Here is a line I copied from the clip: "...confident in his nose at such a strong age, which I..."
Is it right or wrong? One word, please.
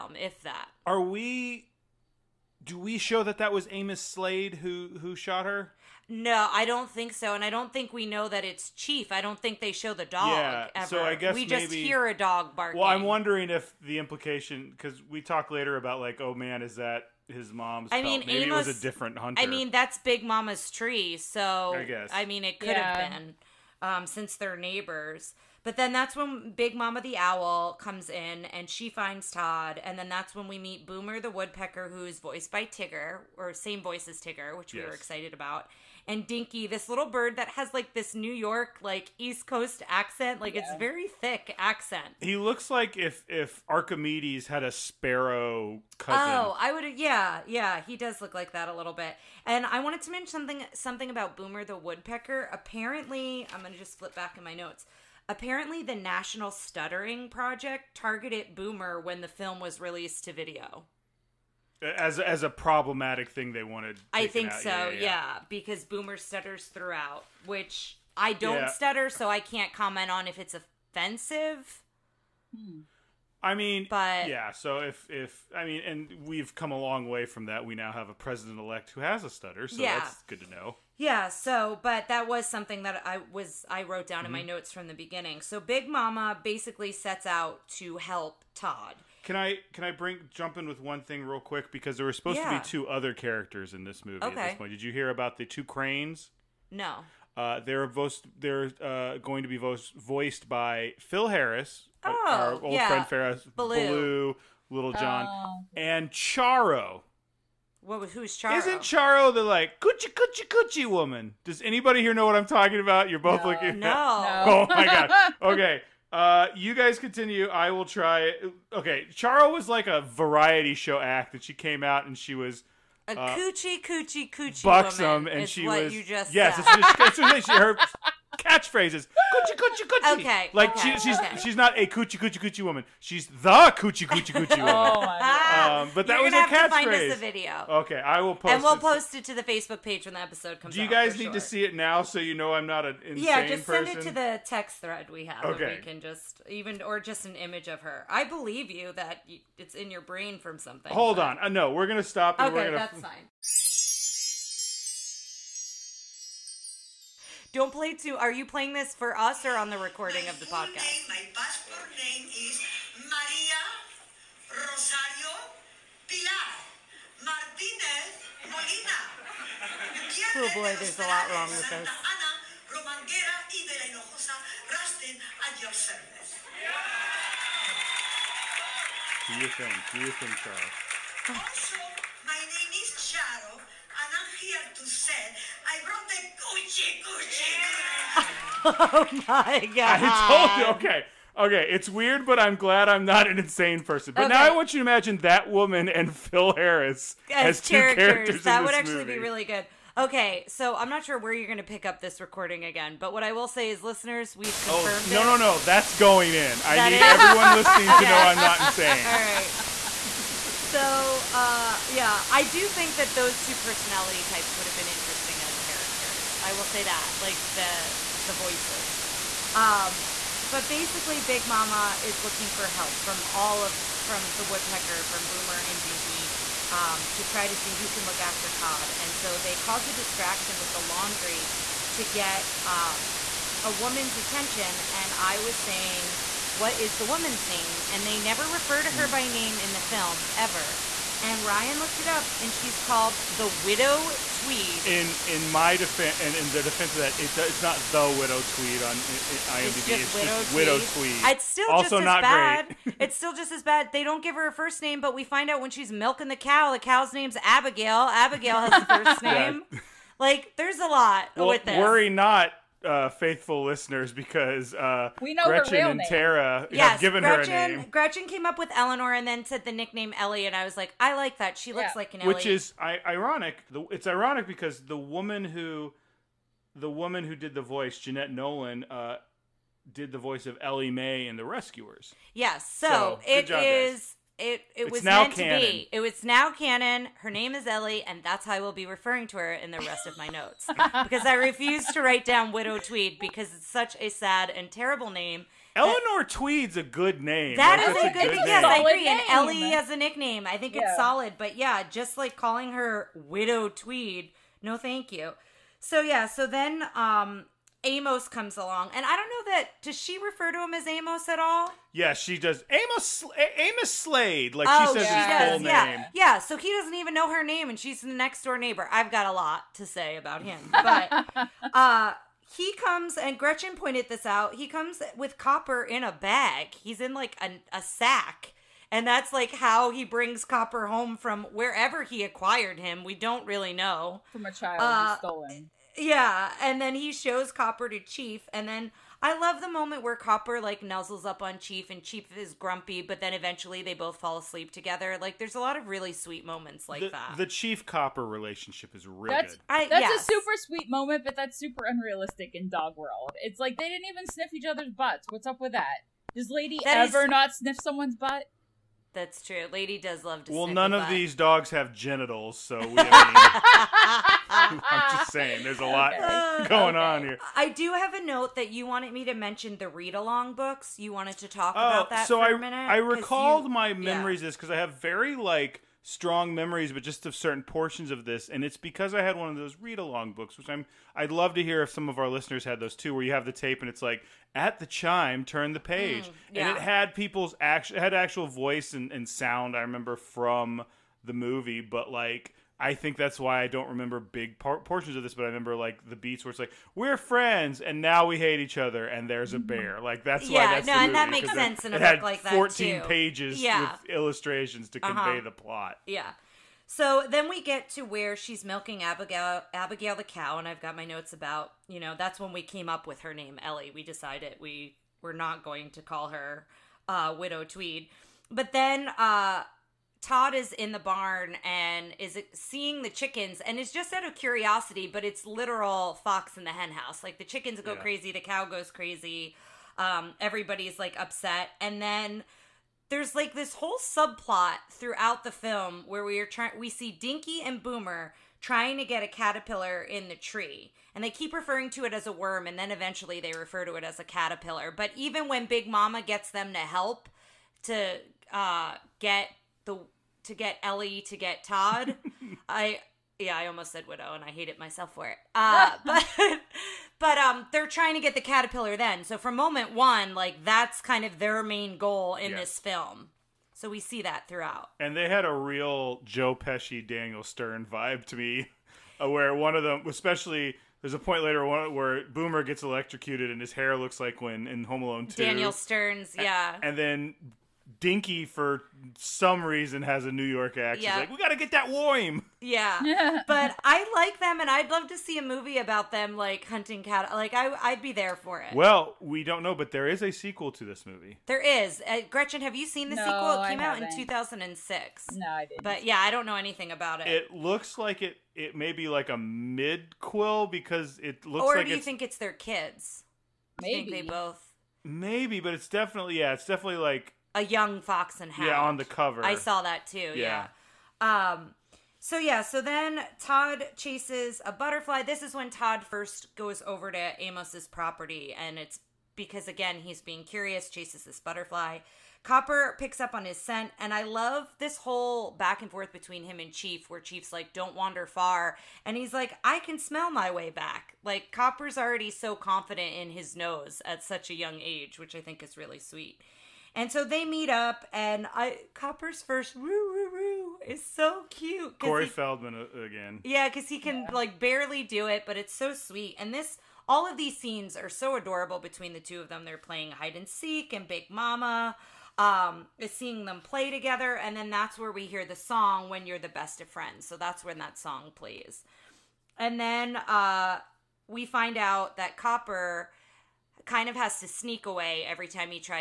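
wrong.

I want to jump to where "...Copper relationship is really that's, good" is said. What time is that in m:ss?
5:47.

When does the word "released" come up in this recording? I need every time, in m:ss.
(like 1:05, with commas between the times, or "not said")
0:59.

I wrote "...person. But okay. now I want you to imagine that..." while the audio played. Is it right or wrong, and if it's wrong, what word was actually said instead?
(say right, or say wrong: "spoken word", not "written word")
right.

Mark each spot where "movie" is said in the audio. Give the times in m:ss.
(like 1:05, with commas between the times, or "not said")
1:34, 3:18, 6:31, 6:40, 8:05, 8:11.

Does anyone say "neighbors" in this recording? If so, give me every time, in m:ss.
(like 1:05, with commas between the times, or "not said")
0:24, 5:18.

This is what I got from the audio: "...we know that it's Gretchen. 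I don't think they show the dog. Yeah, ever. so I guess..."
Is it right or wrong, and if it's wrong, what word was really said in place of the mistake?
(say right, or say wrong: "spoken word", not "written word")
wrong: "Chief", not "Gretchen".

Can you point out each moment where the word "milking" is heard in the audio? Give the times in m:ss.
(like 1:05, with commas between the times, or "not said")
4:15, 6:48.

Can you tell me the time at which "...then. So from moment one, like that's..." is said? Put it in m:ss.
7:38.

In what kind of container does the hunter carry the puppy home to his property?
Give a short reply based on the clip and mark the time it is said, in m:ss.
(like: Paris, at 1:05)
a sack, at 5:27.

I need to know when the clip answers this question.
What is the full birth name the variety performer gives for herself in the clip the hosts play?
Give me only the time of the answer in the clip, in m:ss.
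2:43.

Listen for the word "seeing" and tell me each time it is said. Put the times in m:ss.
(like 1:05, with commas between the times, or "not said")
7:02, 9:13.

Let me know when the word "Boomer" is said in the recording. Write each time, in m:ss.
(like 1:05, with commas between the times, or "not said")
0:30, 0:51, 0:58, 1:05, 3:45, 7:17, 7:52.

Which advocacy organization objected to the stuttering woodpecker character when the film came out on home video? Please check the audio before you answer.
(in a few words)
National Stuttering Project.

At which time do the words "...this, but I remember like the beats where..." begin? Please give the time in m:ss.
6:35.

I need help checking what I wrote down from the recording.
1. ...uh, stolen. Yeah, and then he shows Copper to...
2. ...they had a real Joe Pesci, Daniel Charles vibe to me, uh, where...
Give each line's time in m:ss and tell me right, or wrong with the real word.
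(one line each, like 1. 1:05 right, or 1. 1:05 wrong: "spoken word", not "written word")
1. 5:34 right
2. 7:45 wrong: "Stern", not "Charles".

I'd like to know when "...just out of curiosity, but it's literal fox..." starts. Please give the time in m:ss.
7:03.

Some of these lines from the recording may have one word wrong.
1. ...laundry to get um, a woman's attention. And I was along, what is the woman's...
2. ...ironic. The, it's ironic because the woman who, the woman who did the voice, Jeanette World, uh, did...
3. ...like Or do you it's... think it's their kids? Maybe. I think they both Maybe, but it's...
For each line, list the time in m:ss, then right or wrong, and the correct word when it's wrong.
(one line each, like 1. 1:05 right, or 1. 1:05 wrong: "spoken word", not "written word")
1. 3:50 wrong: "saying", not "along"
2. 4:33 wrong: "Nolan", not "World"
3. 8:21 right.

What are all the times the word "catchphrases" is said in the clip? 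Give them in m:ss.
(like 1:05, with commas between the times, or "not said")
2:08, 2:16.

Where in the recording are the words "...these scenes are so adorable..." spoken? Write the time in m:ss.
9:07.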